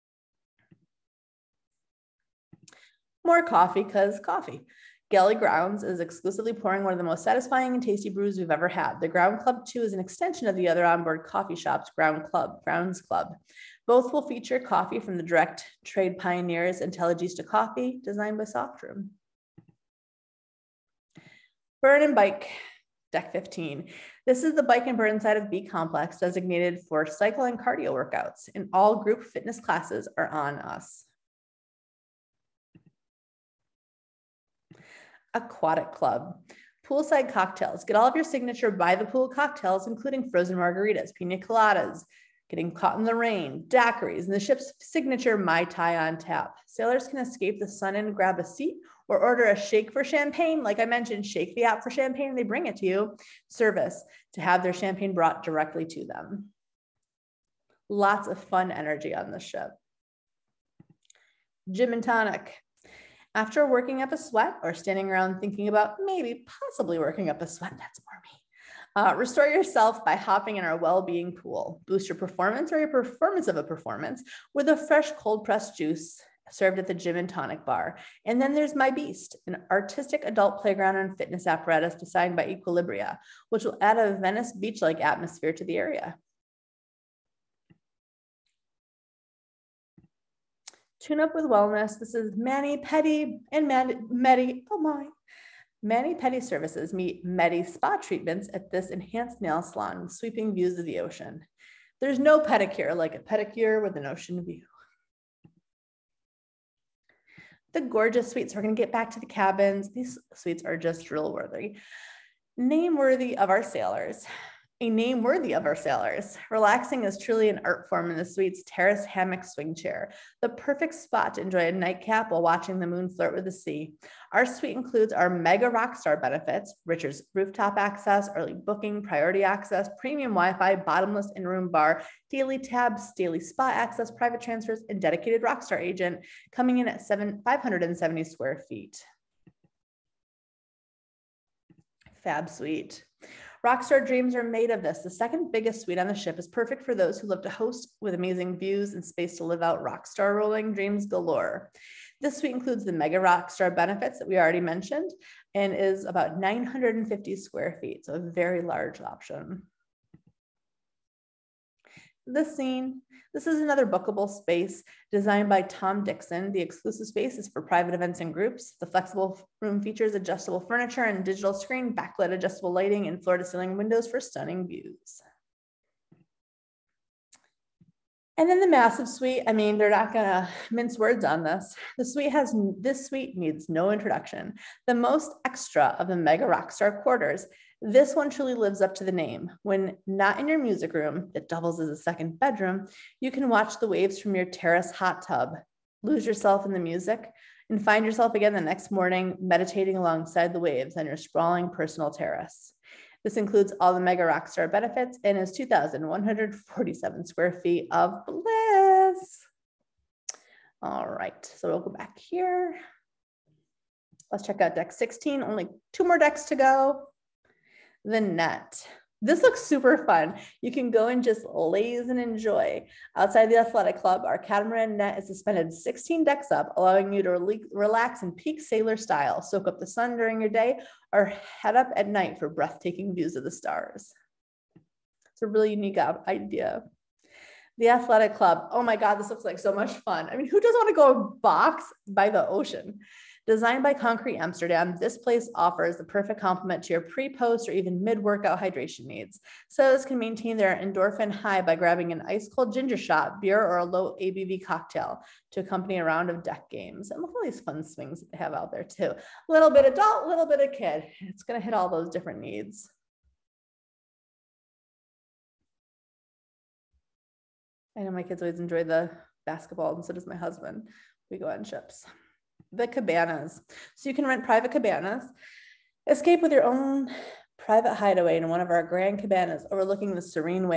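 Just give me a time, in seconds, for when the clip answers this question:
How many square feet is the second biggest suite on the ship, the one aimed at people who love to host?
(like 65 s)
156 s.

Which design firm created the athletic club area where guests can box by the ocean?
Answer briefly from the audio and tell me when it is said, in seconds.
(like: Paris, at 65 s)
Concrete Amsterdam, at 243 s.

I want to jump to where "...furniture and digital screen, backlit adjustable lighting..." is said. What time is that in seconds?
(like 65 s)
170 s.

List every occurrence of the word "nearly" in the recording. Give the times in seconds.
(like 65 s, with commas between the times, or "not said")
not said.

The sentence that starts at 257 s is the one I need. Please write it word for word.
And look at all these fun swings that they have out there too.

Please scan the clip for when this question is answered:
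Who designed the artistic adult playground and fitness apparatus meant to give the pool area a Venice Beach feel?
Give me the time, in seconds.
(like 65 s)
82 s.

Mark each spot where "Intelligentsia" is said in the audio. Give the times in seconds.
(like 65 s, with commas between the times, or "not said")
16 s.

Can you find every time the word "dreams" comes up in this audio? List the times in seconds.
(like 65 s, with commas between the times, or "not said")
144 s, 150 s.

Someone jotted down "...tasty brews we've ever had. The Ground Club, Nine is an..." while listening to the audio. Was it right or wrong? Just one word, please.
wrong.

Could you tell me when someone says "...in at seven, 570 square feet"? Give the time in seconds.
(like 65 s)
136 s.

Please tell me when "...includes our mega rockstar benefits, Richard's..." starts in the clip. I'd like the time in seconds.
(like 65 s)
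124 s.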